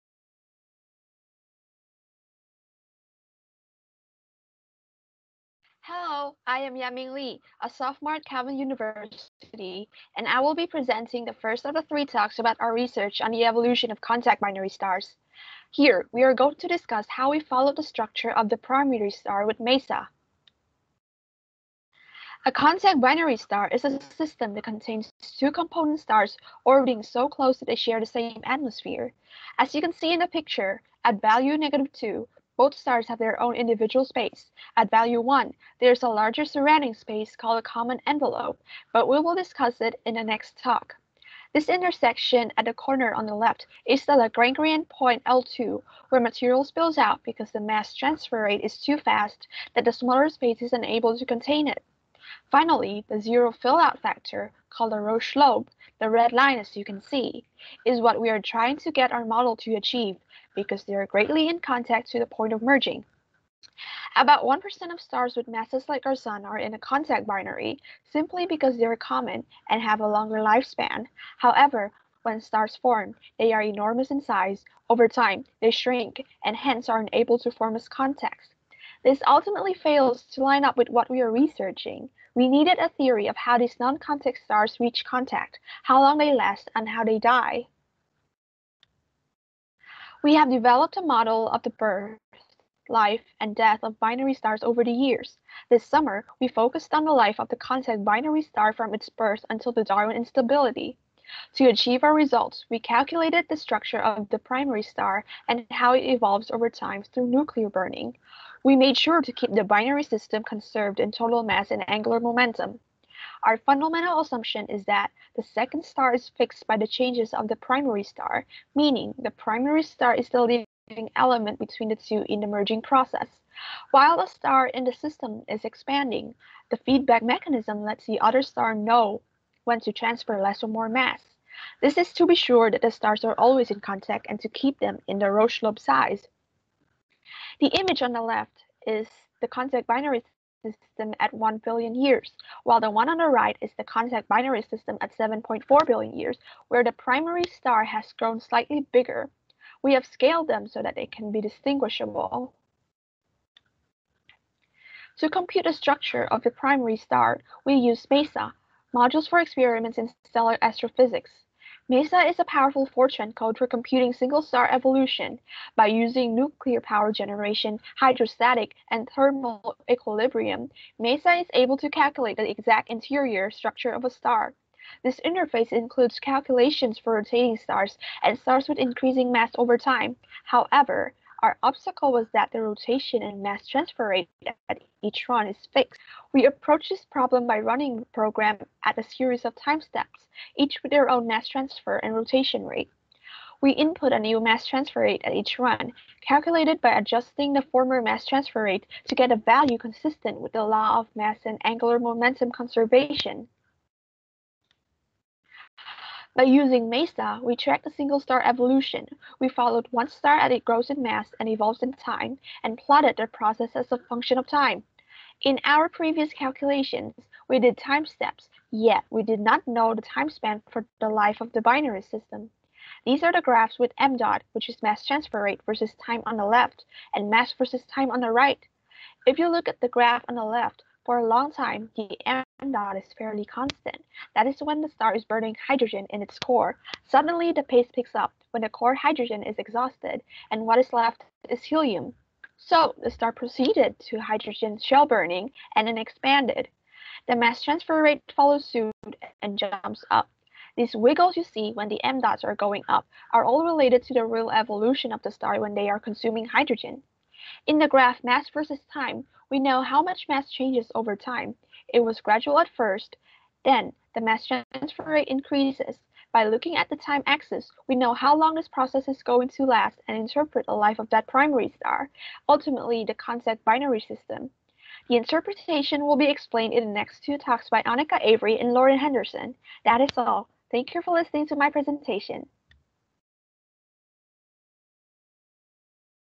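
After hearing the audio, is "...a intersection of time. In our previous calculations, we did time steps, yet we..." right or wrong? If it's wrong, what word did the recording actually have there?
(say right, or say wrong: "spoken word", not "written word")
wrong: "function", not "intersection".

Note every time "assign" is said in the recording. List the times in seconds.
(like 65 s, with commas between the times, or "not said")
not said.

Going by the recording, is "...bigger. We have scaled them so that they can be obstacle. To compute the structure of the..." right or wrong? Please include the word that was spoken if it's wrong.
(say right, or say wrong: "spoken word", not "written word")
wrong: "distinguishable", not "obstacle".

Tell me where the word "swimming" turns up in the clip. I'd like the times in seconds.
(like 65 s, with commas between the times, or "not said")
not said.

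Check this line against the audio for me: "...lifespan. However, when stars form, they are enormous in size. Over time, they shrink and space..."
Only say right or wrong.
wrong.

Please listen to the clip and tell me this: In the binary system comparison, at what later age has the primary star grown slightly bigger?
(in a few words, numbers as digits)
7.4 billion years.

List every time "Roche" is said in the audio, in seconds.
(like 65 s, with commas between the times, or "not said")
55 s, 135 s.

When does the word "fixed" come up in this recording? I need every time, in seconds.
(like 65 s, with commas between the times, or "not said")
116 s, 185 s.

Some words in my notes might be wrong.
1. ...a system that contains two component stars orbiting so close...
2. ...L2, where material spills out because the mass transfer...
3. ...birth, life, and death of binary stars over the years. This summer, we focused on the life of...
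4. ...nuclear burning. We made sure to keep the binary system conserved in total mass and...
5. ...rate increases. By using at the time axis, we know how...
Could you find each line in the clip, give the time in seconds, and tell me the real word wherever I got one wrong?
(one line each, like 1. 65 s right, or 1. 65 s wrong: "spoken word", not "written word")
1. 23 s right
2. 45 s right
3. 91 s right
4. 107 s right
5. 265 s wrong: "looking", not "using".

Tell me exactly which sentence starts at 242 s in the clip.
So the star proceeded to hydrogen shell burning and then expanded.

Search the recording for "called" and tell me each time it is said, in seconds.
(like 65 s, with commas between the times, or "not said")
37 s, 54 s.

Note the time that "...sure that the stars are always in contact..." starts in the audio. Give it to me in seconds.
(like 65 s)
132 s.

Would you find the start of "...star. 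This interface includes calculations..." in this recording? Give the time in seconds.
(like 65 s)
174 s.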